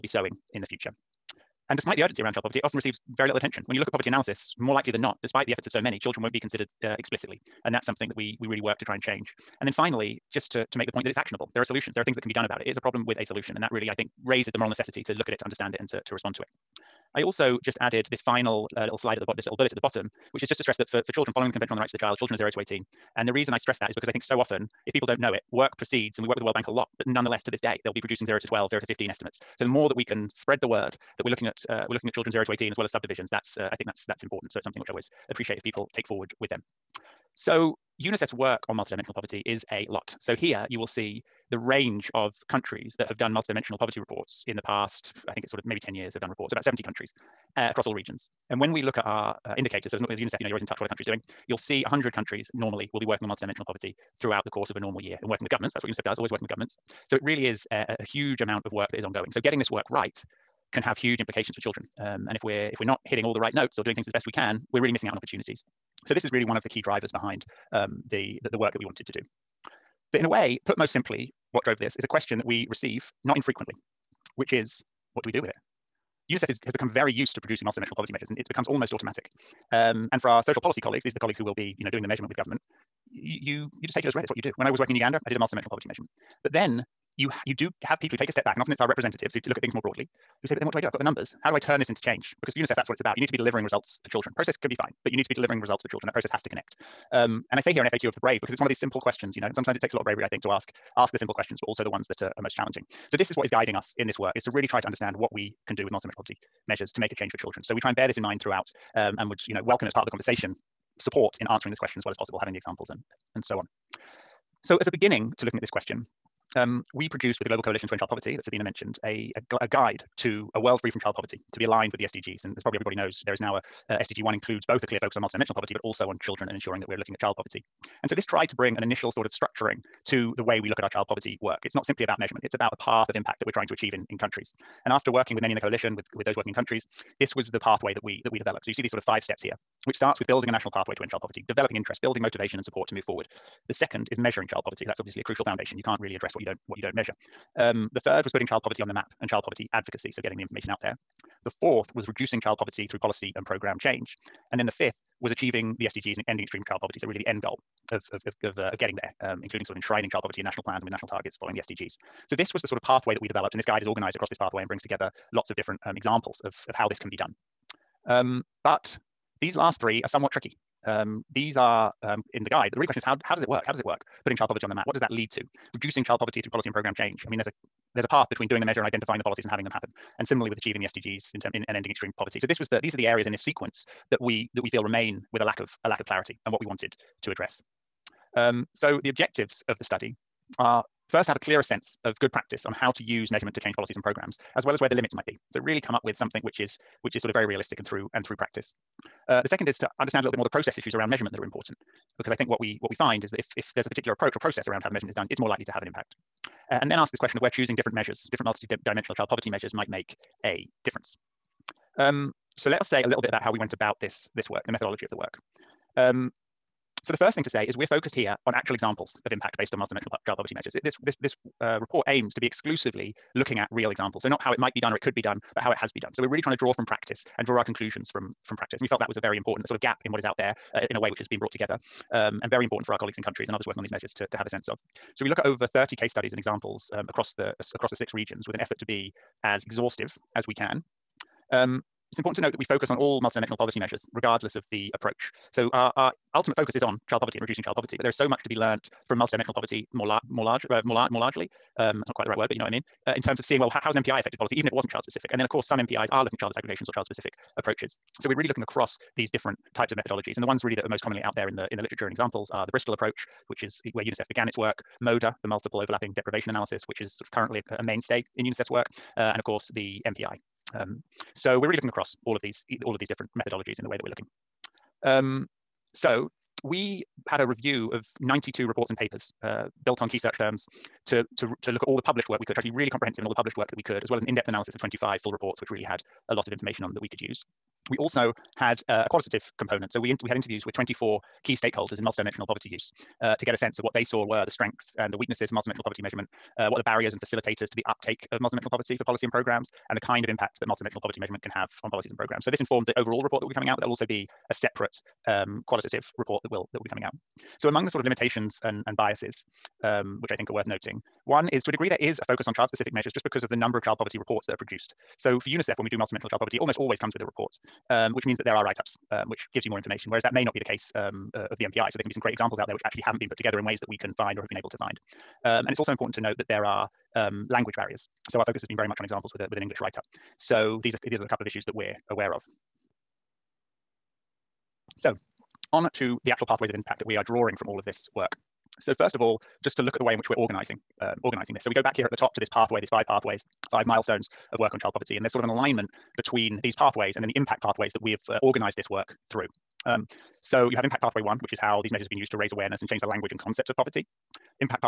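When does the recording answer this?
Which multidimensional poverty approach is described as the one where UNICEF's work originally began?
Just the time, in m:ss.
4:22.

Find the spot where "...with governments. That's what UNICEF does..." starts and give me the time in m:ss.
0:55.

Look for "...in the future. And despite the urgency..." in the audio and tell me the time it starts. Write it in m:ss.
0:00.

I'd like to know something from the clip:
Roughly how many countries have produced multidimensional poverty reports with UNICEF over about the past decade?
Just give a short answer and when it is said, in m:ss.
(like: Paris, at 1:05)
70, at 0:46.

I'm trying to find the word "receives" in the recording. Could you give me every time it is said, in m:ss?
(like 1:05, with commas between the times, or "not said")
0:02, 1:12.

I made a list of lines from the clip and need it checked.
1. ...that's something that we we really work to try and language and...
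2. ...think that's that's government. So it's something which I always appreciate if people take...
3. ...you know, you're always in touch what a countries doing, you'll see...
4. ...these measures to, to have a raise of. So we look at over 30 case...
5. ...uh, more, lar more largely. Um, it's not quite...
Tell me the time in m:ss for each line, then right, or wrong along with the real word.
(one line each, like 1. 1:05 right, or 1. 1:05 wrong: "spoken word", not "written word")
1. 0:07 wrong: "change", not "language"
2. 0:33 wrong: "important", not "government"
3. 0:50 right
4. 3:53 wrong: "sense", not "raise"
5. 4:10 right.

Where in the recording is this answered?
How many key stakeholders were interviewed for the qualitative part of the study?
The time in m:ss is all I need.
4:50.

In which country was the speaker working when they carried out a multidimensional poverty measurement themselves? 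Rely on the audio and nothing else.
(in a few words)
Uganda.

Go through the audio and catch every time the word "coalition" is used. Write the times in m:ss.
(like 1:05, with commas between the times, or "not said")
1:57, 2:15.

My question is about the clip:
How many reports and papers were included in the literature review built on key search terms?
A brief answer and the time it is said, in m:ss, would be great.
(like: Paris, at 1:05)
92, at 4:38.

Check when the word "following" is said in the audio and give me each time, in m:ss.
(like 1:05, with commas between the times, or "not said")
0:21, 2:41.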